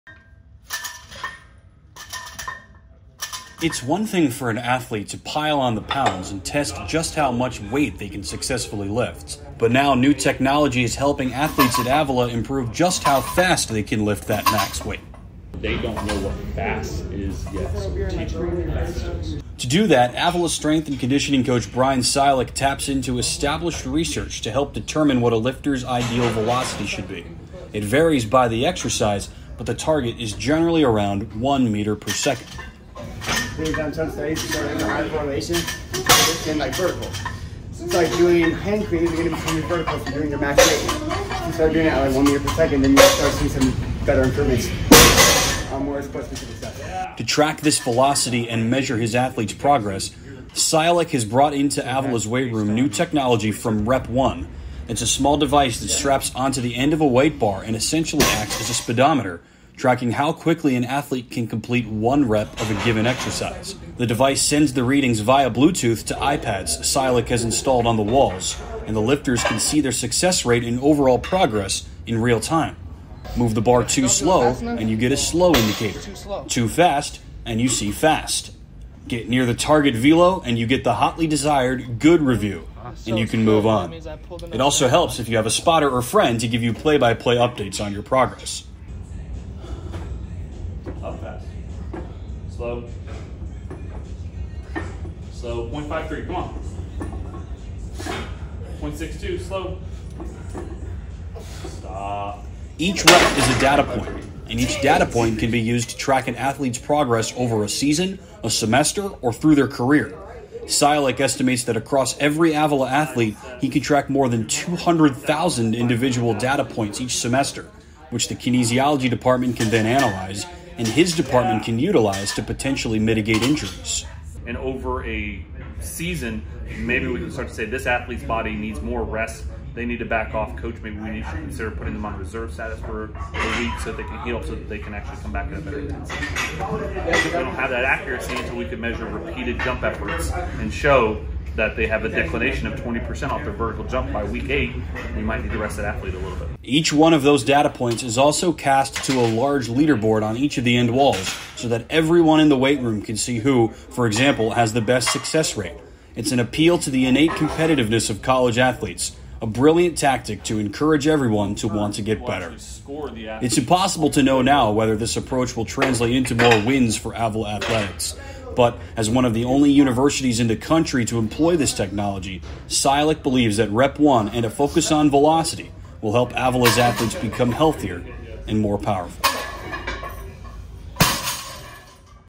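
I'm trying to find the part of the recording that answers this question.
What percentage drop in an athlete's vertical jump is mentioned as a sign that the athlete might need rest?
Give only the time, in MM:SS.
02:22.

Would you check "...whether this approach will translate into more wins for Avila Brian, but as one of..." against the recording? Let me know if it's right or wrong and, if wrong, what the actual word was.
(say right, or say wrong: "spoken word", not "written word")
wrong: "Athletics", not "Brian".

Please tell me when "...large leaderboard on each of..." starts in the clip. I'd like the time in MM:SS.
02:29.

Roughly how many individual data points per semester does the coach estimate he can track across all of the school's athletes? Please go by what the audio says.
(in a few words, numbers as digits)
200,000.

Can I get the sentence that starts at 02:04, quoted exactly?
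And over a season, maybe we can start to say this athlete's body needs more rest.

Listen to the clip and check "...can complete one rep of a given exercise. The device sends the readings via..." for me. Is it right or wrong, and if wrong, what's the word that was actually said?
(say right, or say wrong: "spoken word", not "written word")
right.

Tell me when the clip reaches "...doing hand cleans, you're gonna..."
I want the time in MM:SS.
00:38.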